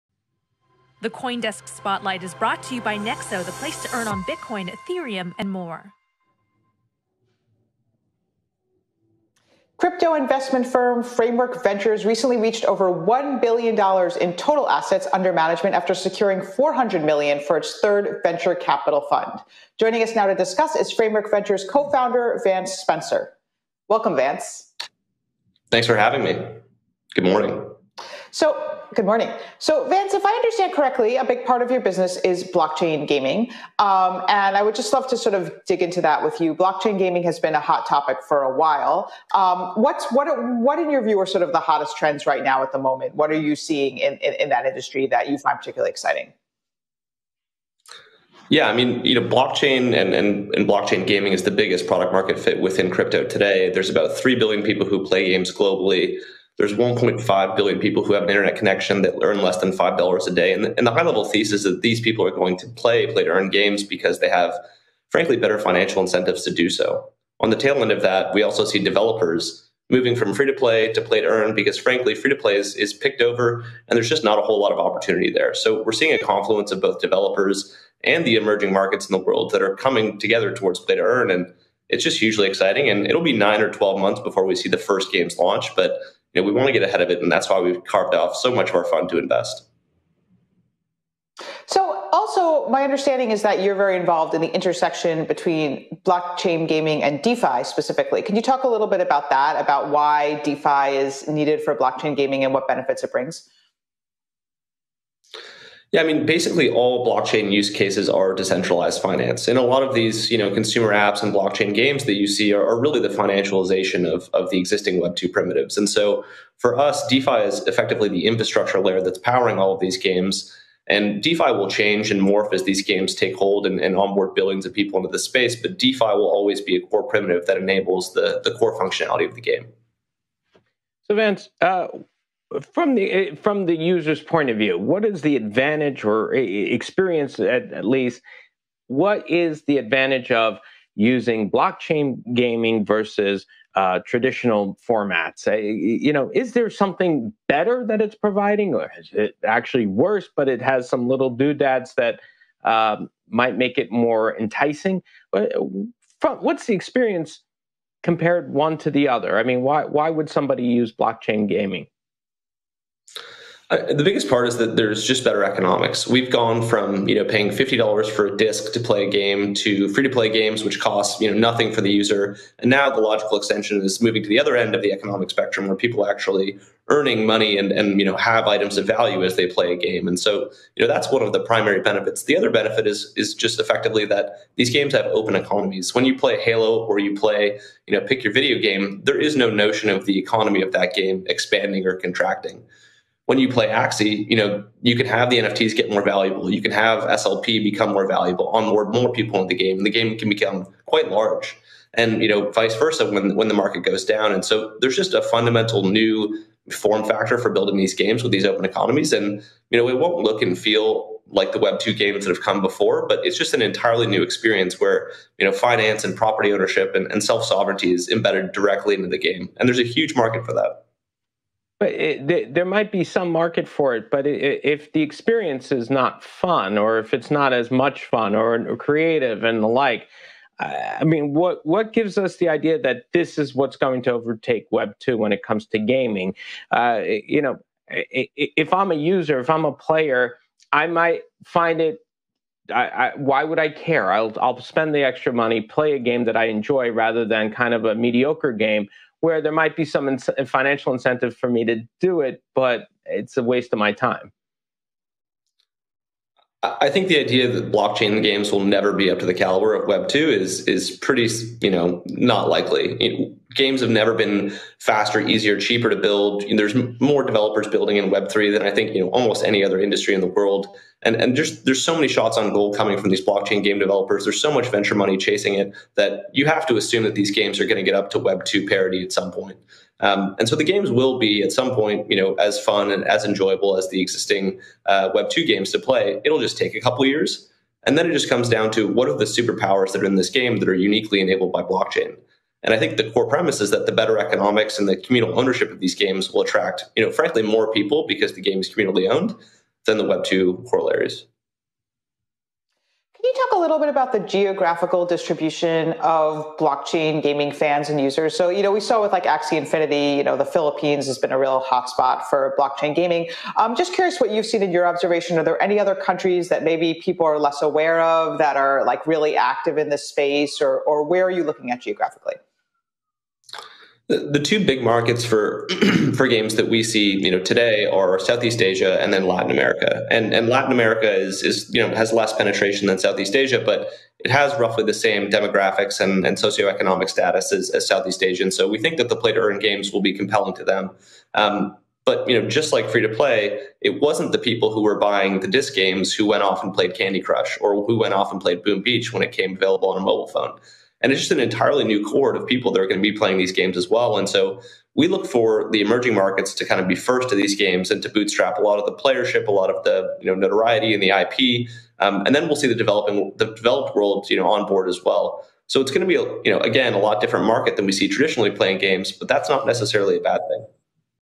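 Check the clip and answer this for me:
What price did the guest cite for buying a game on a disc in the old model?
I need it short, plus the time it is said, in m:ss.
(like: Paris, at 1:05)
$50, at 2:47.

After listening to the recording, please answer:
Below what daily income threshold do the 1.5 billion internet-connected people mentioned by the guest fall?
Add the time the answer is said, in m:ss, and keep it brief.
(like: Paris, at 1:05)
$5 a day, at 0:59.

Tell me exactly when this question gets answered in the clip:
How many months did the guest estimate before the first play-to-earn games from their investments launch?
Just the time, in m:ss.
1:23.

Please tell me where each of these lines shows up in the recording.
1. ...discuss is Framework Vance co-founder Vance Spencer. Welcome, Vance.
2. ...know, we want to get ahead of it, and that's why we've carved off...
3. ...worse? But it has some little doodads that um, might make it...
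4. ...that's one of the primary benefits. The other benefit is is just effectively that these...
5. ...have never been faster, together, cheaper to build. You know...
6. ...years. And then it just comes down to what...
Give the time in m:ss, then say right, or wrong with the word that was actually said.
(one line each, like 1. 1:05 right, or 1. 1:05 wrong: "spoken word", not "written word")
1. 0:20 wrong: "Ventures", not "Vance"
2. 1:26 right
3. 2:29 right
4. 3:00 right
5. 4:23 wrong: "easier", not "together"
6. 4:47 right.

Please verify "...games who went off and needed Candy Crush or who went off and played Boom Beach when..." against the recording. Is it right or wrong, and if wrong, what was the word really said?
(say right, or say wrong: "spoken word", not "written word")
wrong: "played", not "needed".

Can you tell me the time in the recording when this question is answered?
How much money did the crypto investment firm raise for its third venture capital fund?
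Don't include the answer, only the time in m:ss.
0:16.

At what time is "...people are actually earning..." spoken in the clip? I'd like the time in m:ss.
2:55.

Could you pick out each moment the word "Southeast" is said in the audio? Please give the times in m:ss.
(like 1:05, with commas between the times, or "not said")
5:28, 5:32, 5:37.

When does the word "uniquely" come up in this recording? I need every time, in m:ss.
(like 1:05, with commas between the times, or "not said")
4:50.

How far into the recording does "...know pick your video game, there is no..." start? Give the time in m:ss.
3:07.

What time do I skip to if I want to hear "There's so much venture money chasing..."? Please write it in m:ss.
4:34.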